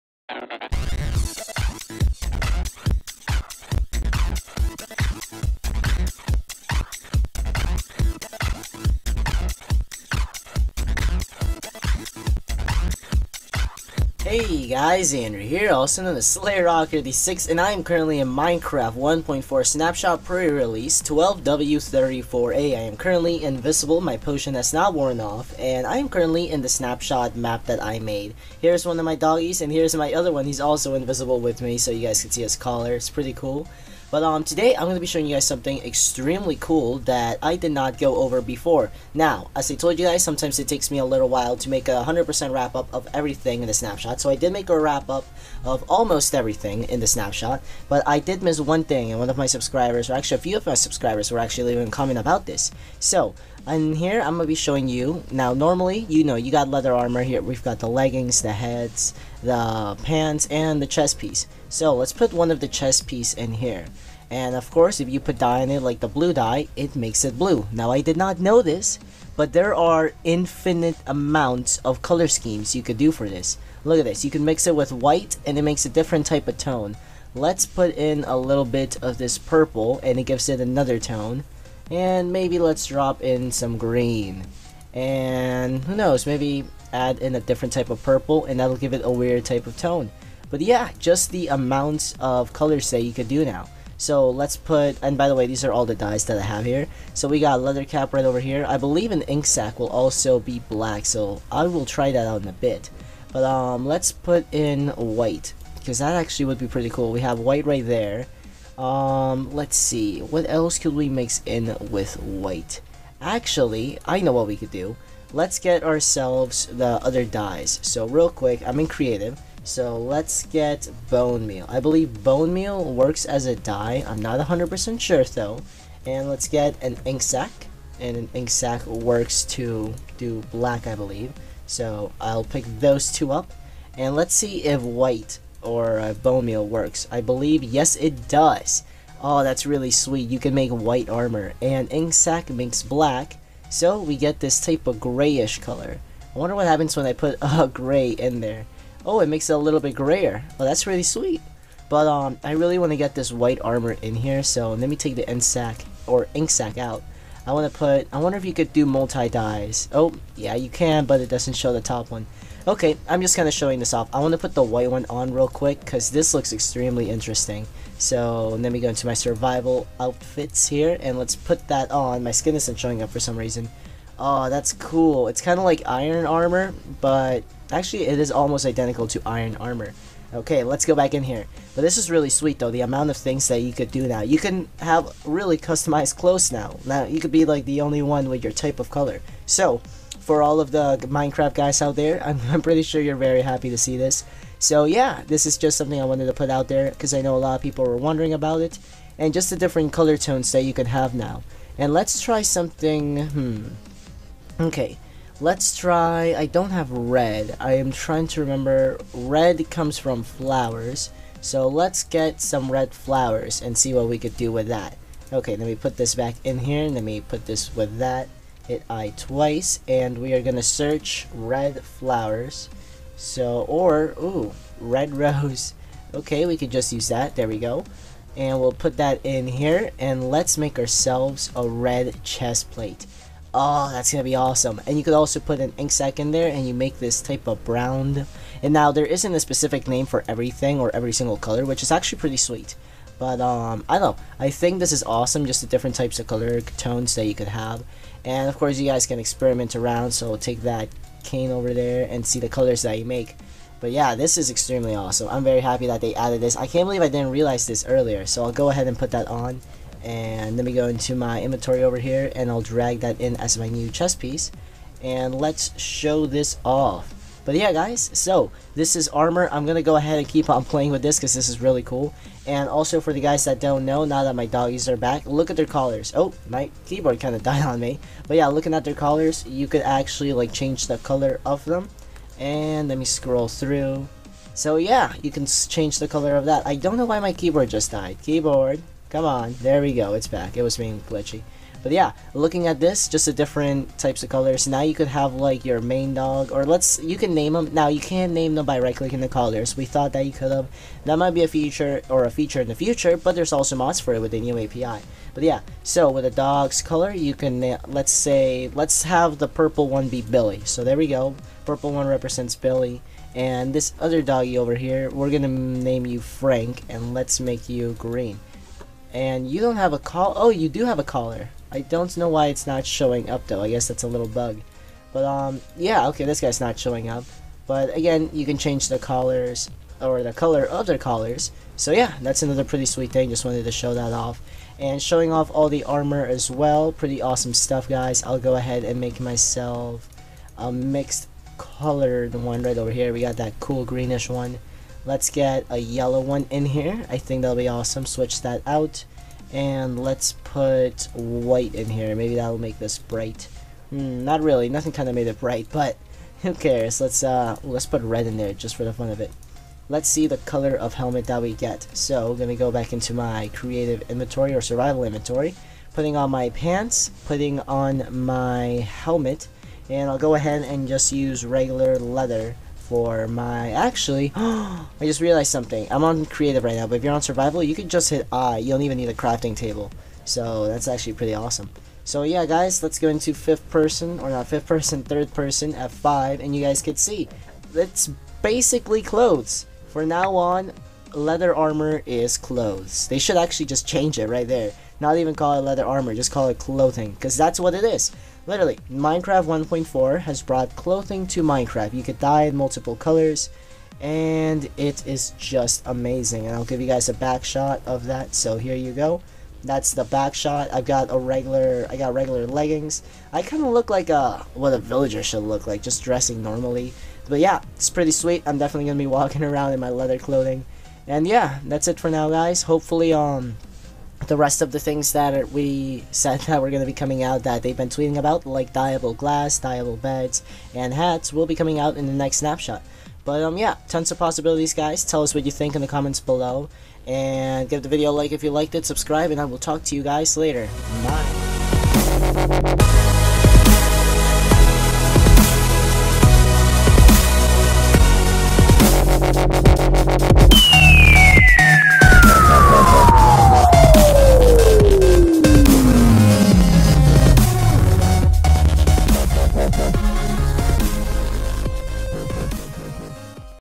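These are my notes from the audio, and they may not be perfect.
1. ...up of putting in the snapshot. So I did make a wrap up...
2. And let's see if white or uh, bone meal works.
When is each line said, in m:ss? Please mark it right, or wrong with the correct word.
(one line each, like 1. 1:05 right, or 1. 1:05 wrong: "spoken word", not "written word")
1. 0:42 wrong: "everything", not "putting"
2. 2:13 right.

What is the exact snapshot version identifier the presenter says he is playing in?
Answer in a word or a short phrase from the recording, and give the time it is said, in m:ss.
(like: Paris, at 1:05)
12W34A, at 0:21.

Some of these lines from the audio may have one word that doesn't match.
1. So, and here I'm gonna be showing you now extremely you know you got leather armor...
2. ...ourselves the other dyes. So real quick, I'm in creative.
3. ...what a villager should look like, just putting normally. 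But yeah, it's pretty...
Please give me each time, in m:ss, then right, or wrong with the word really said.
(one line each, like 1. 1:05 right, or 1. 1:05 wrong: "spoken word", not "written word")
1. 0:52 wrong: "normally", not "extremely"
2. 1:55 right
3. 6:54 wrong: "dressing", not "putting".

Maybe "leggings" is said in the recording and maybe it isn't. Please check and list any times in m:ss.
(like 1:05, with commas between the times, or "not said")
0:57, 6:52.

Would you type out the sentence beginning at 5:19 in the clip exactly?
And you don't have a call.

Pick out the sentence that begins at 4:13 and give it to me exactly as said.
But yeah, this is extremely awesome.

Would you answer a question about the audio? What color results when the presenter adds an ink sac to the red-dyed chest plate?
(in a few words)
brown.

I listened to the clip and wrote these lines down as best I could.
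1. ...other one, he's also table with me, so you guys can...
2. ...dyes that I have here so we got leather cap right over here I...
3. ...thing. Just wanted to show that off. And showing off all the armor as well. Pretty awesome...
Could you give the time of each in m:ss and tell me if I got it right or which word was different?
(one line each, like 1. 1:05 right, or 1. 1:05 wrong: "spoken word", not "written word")
1. 0:30 wrong: "invisible", not "table"
2. 1:35 right
3. 5:33 right.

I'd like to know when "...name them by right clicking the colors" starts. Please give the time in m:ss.
4:58.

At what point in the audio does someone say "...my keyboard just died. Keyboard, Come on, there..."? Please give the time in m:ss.
4:47.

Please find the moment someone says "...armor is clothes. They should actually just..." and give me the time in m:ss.
6:31.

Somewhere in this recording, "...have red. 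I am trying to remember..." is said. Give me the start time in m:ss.
3:26.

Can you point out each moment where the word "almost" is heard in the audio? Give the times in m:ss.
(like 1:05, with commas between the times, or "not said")
0:45, 2:58.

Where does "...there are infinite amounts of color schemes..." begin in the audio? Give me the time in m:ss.
1:09.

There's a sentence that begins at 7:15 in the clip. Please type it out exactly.
Tell us what you think in the comments below.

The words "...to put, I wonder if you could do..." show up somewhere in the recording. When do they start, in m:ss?
2:37.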